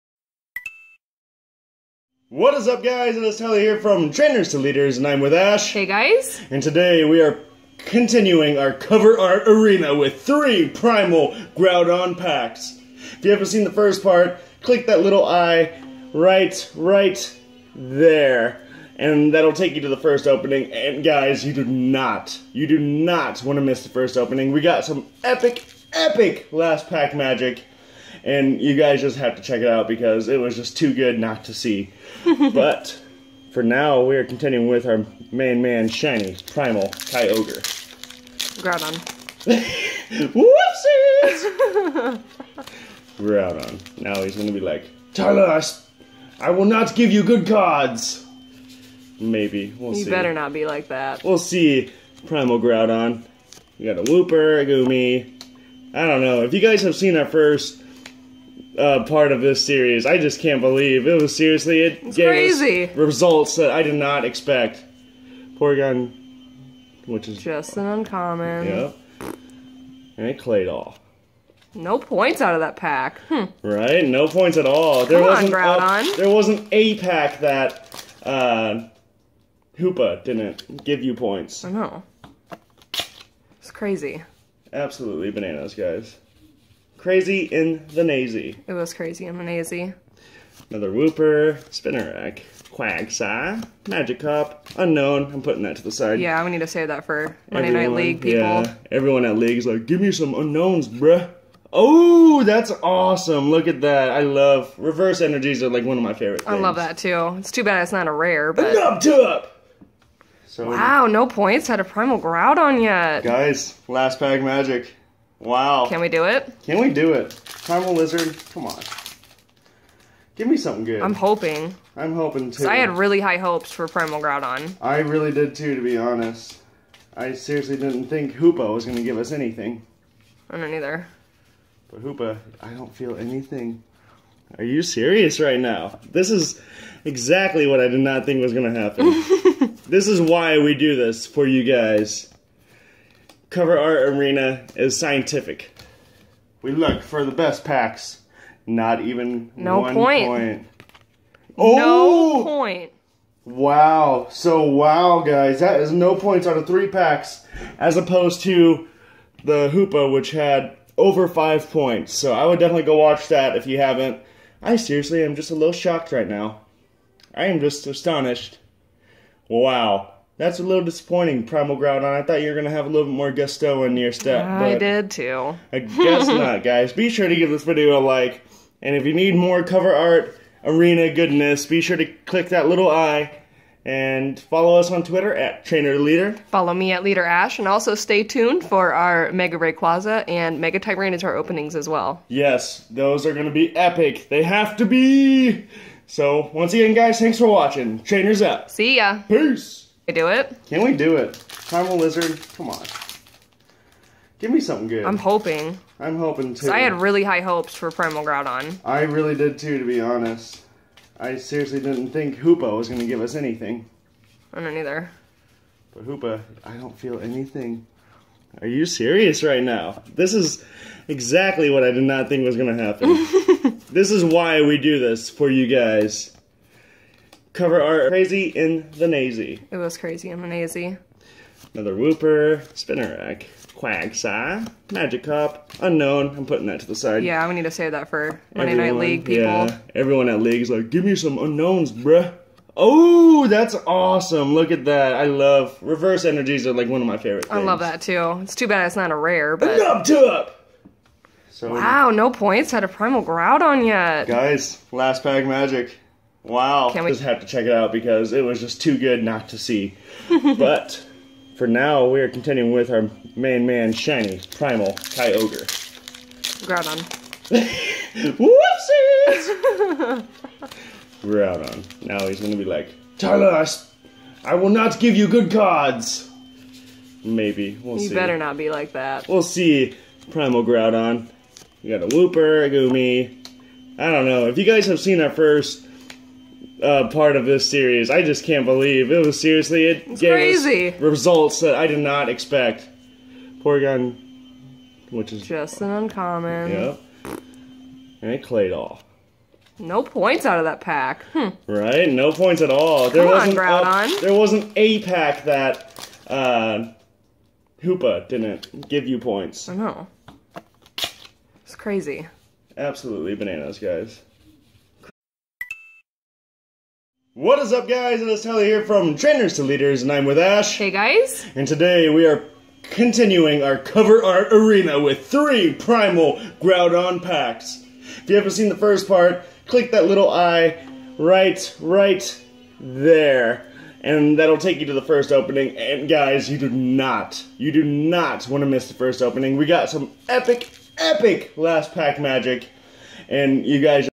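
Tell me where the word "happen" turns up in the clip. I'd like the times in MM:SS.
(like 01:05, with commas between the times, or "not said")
02:18, 03:42.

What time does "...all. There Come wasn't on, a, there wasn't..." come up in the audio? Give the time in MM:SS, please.
01:14.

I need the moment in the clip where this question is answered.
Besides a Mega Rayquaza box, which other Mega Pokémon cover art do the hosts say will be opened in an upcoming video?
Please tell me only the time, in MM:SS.
03:10.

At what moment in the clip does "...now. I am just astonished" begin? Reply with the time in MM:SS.
02:46.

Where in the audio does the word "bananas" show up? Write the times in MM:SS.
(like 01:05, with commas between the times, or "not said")
01:25, 05:13.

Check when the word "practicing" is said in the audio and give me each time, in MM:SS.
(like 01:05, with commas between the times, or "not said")
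not said.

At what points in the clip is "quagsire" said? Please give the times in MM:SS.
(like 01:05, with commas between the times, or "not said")
01:32, 03:53.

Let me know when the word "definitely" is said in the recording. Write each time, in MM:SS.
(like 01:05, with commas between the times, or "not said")
02:42.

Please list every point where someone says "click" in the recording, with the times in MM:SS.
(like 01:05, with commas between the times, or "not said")
00:14, 03:02, 05:29.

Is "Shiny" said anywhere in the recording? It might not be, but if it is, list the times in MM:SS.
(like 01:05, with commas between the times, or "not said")
00:35, 04:23.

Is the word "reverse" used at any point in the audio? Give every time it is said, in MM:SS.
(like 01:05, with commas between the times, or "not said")
01:44, 04:05.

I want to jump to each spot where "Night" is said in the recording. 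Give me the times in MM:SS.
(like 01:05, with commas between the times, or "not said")
01:37, 03:58.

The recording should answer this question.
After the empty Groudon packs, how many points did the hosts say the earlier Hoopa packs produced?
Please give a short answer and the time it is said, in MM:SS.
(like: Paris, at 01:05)
Over 5, at 02:41.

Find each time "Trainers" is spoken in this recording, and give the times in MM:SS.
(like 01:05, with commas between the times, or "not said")
00:04, 03:05, 03:18, 05:19.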